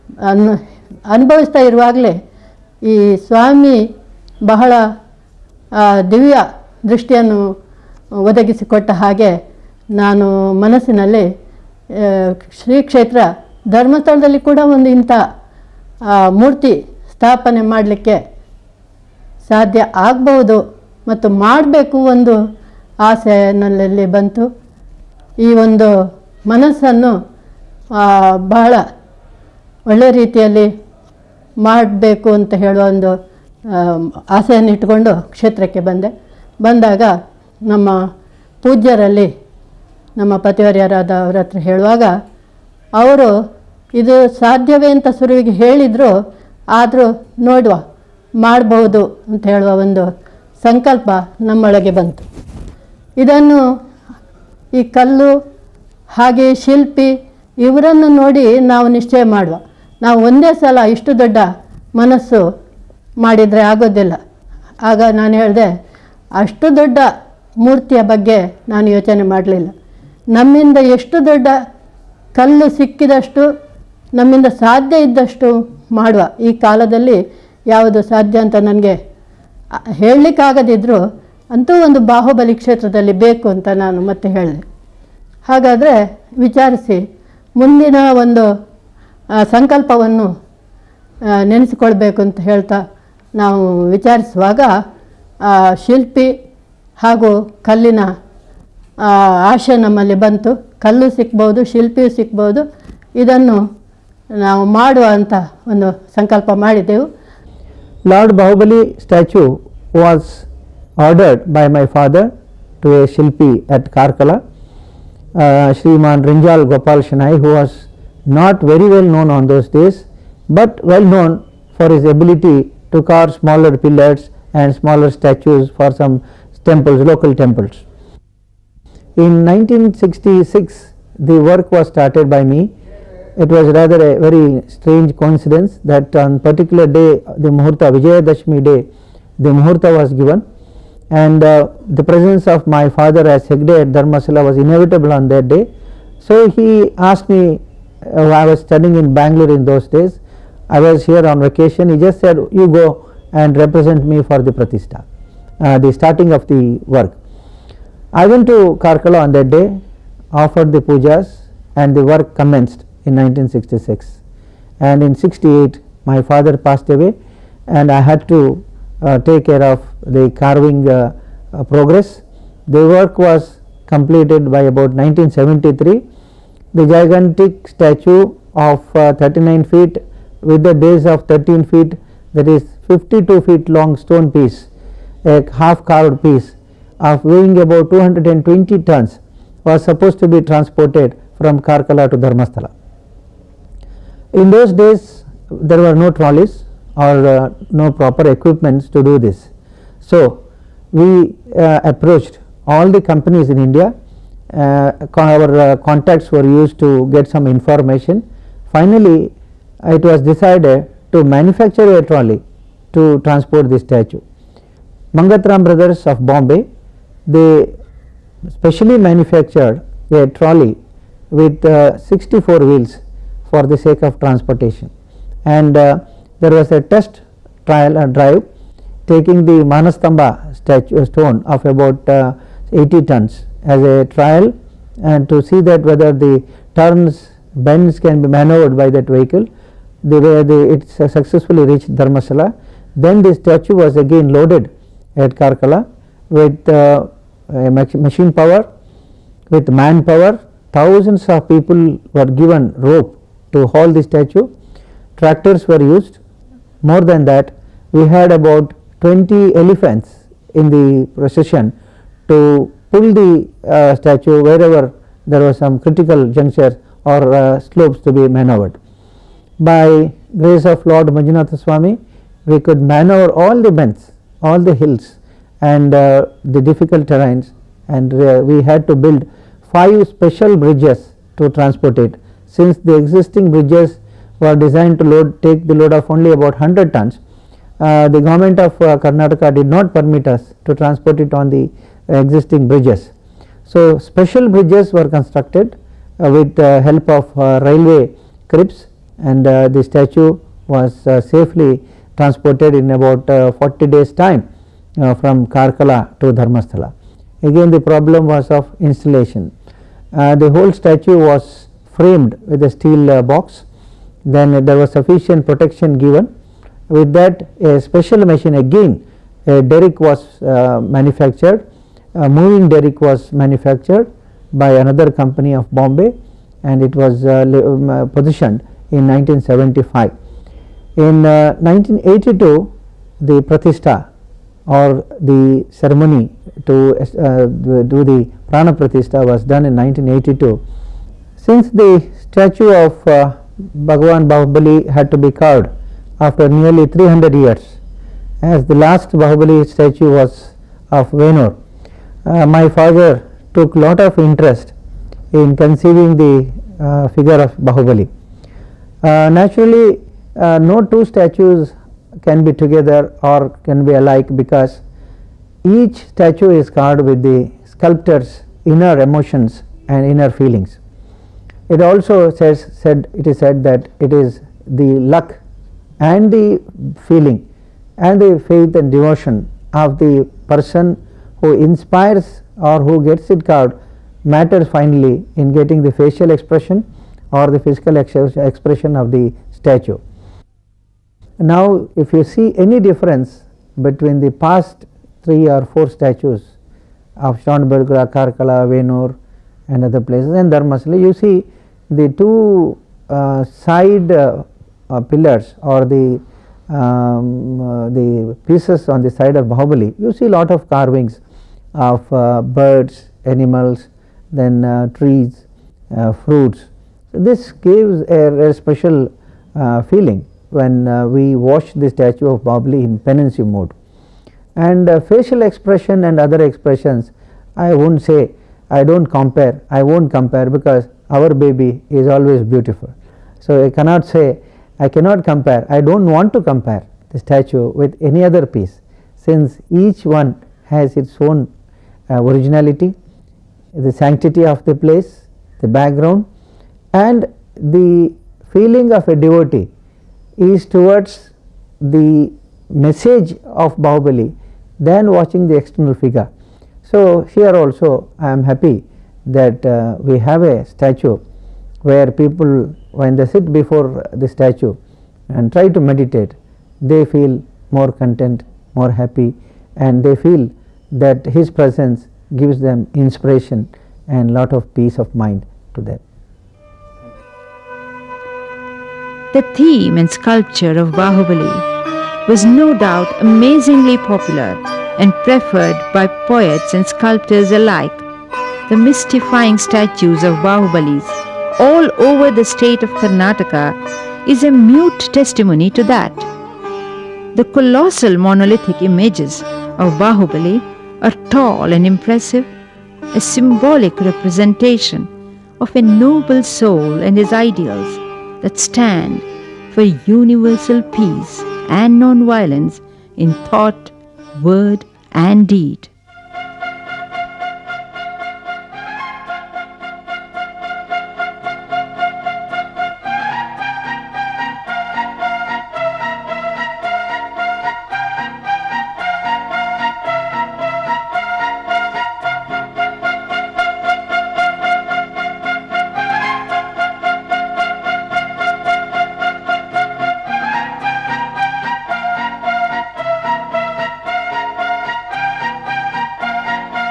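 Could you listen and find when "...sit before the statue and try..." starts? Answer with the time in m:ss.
7:43.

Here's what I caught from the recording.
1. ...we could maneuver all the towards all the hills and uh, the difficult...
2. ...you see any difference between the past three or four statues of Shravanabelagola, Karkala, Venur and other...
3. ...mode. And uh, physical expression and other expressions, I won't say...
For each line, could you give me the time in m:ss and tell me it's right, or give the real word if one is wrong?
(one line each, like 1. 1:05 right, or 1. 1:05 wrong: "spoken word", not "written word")
1. 4:32 wrong: "bends", not "towards"
2. 6:32 right
3. 7:03 wrong: "facial", not "physical".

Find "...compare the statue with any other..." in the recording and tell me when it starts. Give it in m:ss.
7:16.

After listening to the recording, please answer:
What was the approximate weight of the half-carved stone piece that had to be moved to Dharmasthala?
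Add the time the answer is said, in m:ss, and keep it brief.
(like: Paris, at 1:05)
220 tons, at 3:07.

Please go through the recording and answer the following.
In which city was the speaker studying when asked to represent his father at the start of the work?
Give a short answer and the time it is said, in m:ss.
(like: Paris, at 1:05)
Bangalore, at 2:29.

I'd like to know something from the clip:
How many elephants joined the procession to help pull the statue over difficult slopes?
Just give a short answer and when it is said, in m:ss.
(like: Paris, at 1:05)
20, at 4:19.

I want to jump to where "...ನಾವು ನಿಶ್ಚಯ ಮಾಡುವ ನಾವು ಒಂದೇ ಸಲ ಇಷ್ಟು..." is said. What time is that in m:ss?
0:58.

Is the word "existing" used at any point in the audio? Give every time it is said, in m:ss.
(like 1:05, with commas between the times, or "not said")
4:42, 4:52.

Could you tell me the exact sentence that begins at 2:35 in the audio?
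Uh, the starting of the work.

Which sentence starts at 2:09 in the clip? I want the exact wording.
In 1966, the work was started by me.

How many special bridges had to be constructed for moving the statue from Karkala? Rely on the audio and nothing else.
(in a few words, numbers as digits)
5.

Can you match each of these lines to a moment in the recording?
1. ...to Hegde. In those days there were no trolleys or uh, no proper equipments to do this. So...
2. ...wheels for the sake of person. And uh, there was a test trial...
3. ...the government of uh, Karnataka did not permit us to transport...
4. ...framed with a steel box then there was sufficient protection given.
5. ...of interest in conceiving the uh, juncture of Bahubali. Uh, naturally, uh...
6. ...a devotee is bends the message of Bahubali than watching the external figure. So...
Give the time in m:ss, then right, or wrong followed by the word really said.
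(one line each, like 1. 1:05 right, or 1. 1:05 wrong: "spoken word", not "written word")
1. 3:12 wrong: "Dharmasthala", not "Hegde"
2. 3:42 wrong: "transportation", not "person"
3. 4:48 right
4. 5:12 right
5. 5:53 wrong: "figure", not "juncture"
6. 7:29 wrong: "towards", not "bends".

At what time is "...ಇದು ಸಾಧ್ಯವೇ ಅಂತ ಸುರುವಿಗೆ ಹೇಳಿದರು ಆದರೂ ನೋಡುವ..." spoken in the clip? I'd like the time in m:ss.
0:44.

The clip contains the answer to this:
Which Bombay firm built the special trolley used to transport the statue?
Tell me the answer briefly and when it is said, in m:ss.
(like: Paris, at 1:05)
Mangatram Brothers, at 3:35.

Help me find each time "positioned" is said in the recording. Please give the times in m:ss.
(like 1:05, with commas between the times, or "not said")
5:28.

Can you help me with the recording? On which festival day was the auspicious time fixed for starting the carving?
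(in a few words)
Vijayadashmi.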